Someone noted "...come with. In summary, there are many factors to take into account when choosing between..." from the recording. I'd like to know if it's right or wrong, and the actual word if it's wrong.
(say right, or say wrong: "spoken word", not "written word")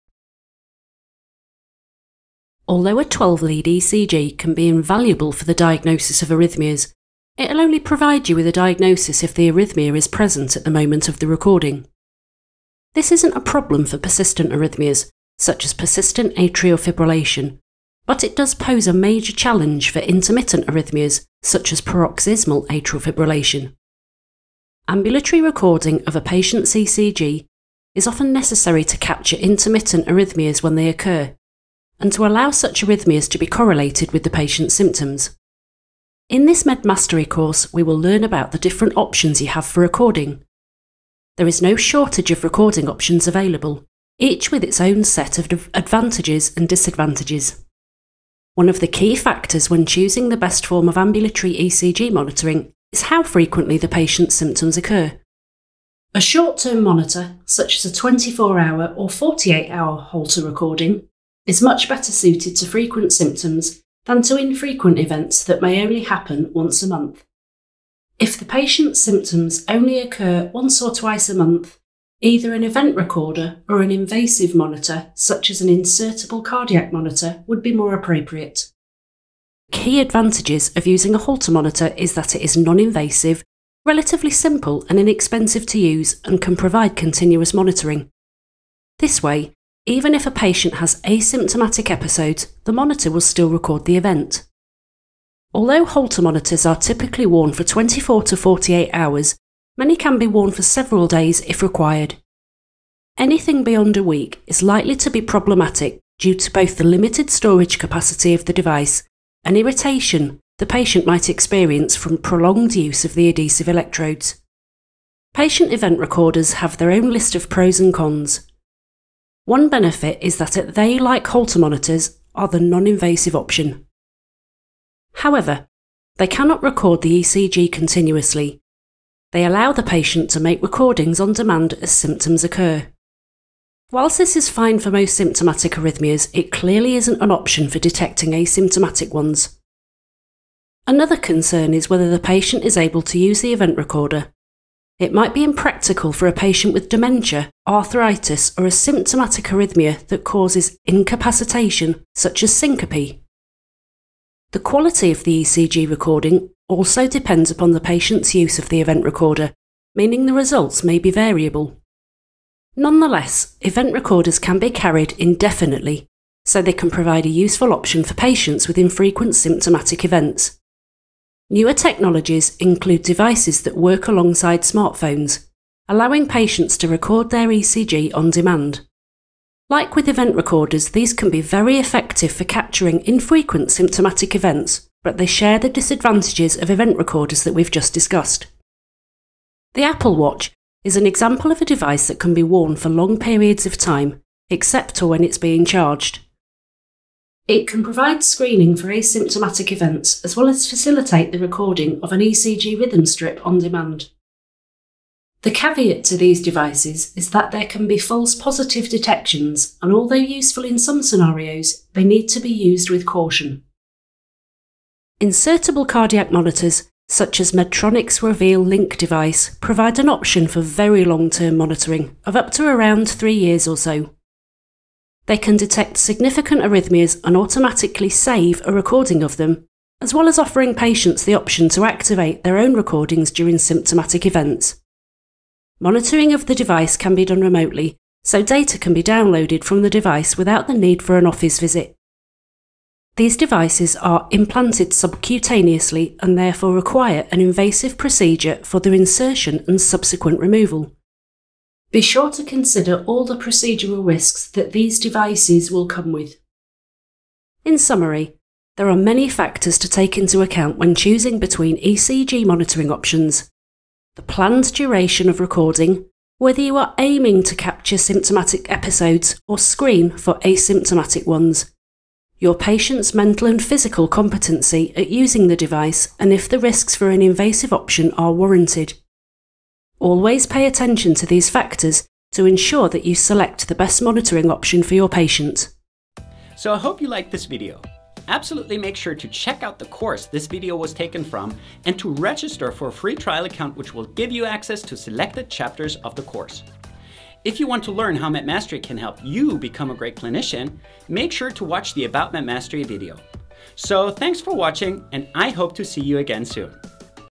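right.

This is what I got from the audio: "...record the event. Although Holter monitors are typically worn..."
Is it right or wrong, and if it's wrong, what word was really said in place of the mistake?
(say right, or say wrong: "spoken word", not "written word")
right.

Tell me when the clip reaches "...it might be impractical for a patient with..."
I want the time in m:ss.
2:25.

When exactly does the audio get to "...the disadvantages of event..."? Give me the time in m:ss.
3:05.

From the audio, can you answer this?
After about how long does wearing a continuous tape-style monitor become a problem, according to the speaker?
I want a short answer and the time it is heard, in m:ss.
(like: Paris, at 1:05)
a week, at 1:43.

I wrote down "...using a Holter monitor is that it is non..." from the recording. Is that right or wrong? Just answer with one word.
right.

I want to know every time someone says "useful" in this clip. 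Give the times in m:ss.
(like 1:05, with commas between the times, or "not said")
2:47, 3:30.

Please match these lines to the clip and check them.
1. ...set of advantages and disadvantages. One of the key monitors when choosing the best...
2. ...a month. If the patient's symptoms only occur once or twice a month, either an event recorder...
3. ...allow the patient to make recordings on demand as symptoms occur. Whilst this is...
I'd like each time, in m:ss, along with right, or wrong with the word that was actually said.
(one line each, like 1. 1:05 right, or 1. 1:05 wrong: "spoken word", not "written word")
1. 0:45 wrong: "factors", not "monitors"
2. 1:06 right
3. 2:09 right.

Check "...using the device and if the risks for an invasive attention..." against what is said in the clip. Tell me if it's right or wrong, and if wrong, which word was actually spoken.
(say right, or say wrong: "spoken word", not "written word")
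wrong: "option", not "attention".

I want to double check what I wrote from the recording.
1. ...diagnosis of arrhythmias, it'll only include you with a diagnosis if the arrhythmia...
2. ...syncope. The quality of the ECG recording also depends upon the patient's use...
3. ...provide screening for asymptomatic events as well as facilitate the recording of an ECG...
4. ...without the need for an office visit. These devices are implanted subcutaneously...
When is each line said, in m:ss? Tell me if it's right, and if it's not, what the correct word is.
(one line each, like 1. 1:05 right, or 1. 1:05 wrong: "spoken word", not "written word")
1. 0:05 wrong: "provide", not "include"
2. 2:32 right
3. 3:17 right
4. 4:00 right.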